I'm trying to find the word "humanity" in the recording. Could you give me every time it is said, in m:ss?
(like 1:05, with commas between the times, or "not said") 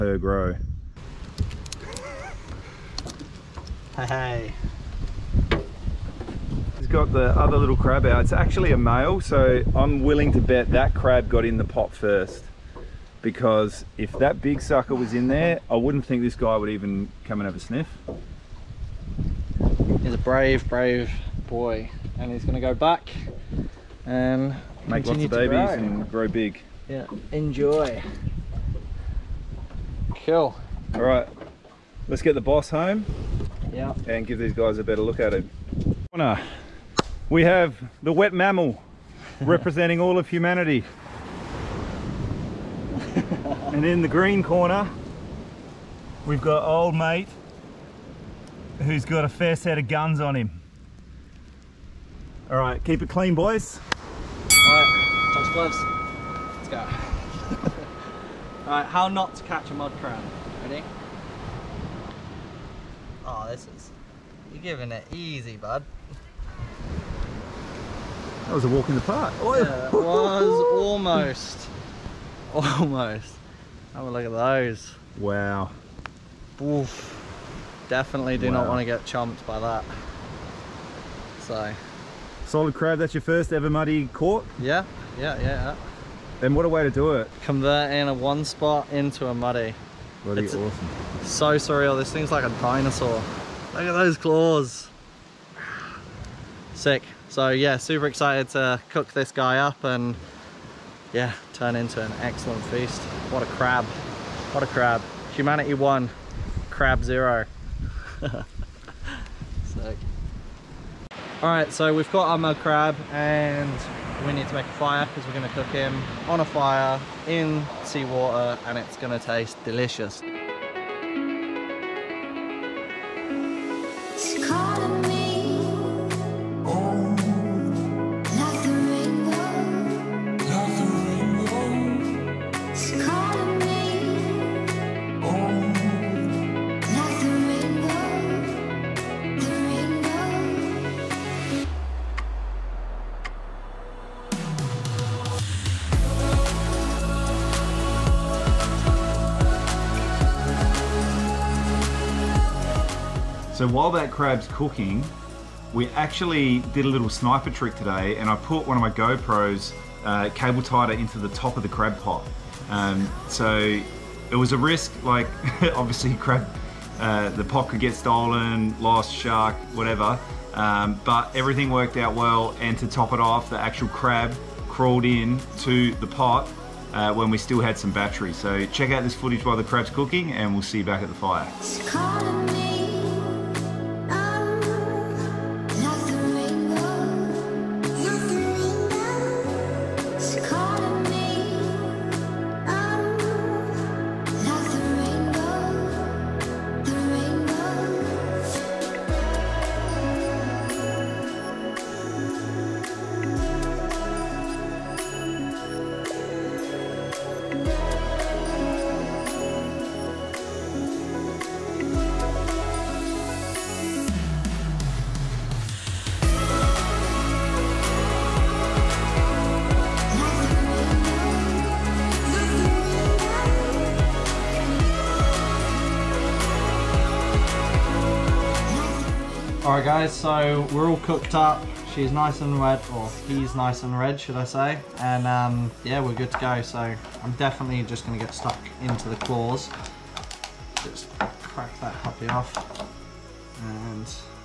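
0:40, 1:45.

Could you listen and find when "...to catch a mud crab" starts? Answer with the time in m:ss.
0:59.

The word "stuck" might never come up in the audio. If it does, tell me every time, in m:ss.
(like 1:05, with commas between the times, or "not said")
3:58.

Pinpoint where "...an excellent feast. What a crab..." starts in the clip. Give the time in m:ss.
1:42.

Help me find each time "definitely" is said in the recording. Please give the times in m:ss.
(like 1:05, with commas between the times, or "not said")
1:17, 3:57.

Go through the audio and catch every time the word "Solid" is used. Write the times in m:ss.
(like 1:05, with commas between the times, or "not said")
1:22.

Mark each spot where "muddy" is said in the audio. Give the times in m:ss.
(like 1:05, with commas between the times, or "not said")
1:23, 1:29.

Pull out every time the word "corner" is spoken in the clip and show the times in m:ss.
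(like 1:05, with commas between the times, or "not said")
0:36, 0:44.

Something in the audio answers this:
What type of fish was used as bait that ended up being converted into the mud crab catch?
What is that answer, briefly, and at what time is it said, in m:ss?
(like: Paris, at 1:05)
one spot, at 1:28.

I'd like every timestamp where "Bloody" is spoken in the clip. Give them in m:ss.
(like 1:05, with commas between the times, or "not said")
1:30.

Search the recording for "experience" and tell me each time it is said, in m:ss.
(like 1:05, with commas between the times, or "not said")
not said.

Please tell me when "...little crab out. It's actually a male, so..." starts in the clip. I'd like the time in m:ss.
0:07.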